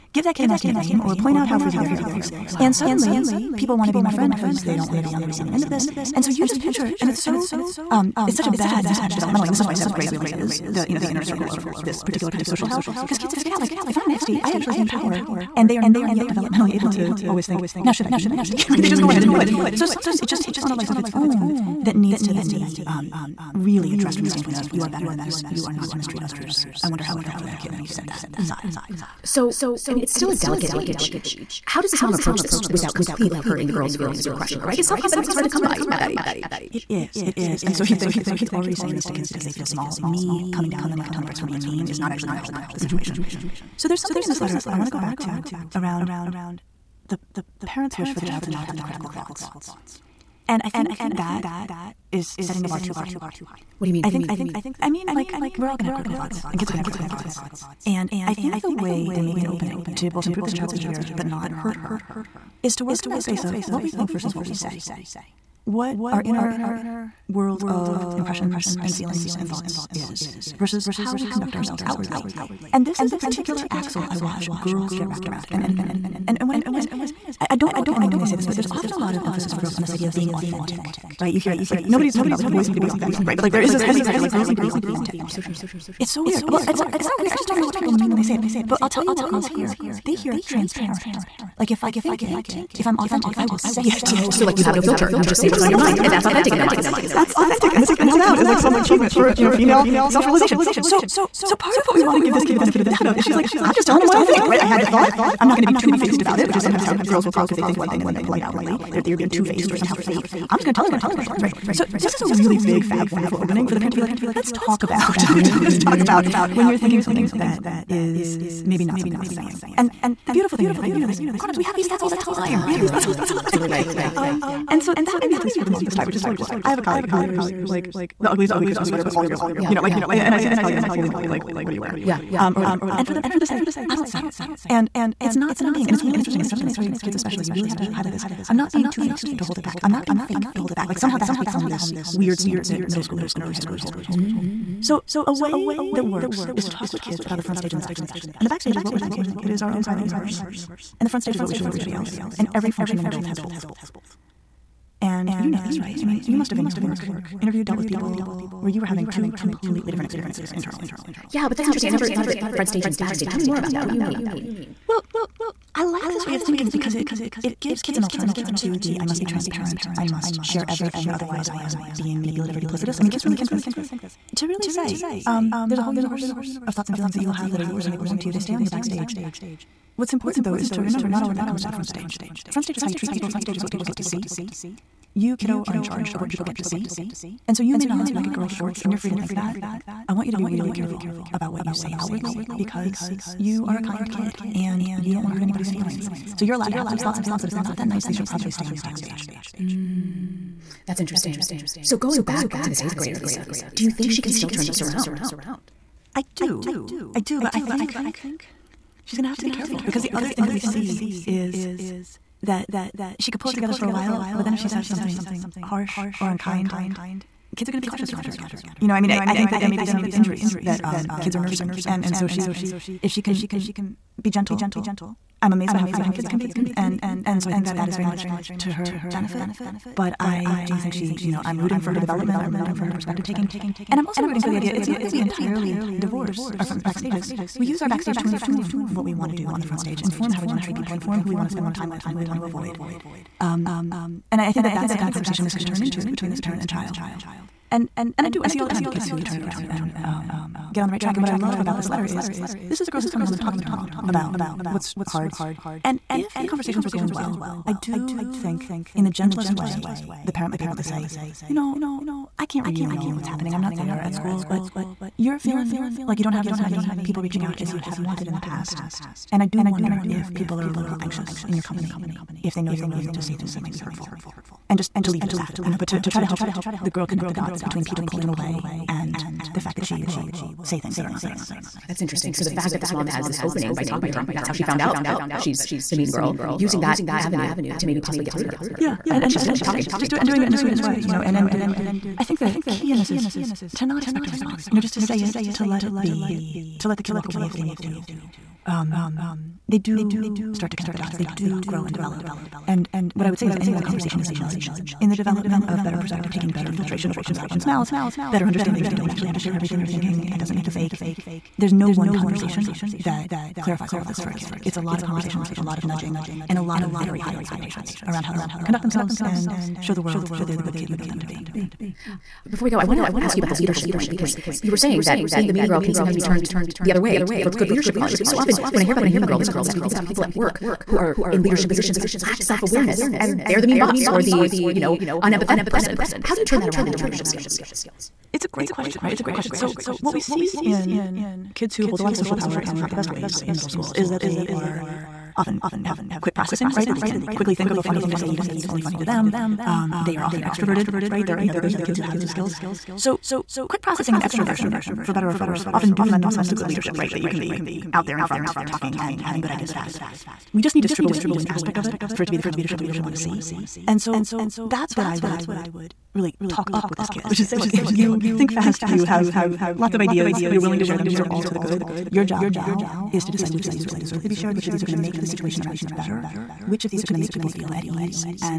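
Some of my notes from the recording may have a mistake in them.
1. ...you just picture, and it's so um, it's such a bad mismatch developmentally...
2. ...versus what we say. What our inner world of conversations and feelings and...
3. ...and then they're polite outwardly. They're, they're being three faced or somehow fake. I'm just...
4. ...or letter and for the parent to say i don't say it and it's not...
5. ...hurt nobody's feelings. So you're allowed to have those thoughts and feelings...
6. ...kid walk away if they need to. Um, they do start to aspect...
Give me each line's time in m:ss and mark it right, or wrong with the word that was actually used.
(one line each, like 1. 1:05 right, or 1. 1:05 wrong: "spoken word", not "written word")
1. 0:06 right
2. 1:04 wrong: "impressions", not "conversations"
3. 1:48 wrong: "two", not "three"
4. 2:12 wrong: "whatever", not "letter"
5. 3:15 wrong: "anybody", not "nobody"
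6. 4:57 wrong: "connect", not "aspect".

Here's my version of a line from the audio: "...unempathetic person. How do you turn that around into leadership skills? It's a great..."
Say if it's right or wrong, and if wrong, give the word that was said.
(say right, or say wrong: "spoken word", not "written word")
right.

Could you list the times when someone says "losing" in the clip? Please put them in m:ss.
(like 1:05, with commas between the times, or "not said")
not said.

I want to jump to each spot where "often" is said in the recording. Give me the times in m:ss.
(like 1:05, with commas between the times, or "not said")
1:18, 5:28, 5:45, 5:50, 5:55.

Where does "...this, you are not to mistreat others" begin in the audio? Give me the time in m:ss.
0:25.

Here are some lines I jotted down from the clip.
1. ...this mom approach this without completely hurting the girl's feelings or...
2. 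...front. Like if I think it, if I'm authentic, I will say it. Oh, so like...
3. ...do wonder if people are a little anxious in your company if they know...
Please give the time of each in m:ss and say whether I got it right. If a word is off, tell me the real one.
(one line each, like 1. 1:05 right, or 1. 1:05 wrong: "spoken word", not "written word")
1. 0:31 right
2. 1:30 wrong: "transparent", not "front"
3. 4:29 right.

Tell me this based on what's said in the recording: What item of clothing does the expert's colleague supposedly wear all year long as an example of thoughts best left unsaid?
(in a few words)
ugly Christmas sweater.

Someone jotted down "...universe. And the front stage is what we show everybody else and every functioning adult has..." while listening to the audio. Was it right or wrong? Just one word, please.
right.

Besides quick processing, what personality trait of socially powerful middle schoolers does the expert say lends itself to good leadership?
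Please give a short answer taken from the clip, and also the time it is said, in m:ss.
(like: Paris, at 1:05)
extroversion, at 5:54.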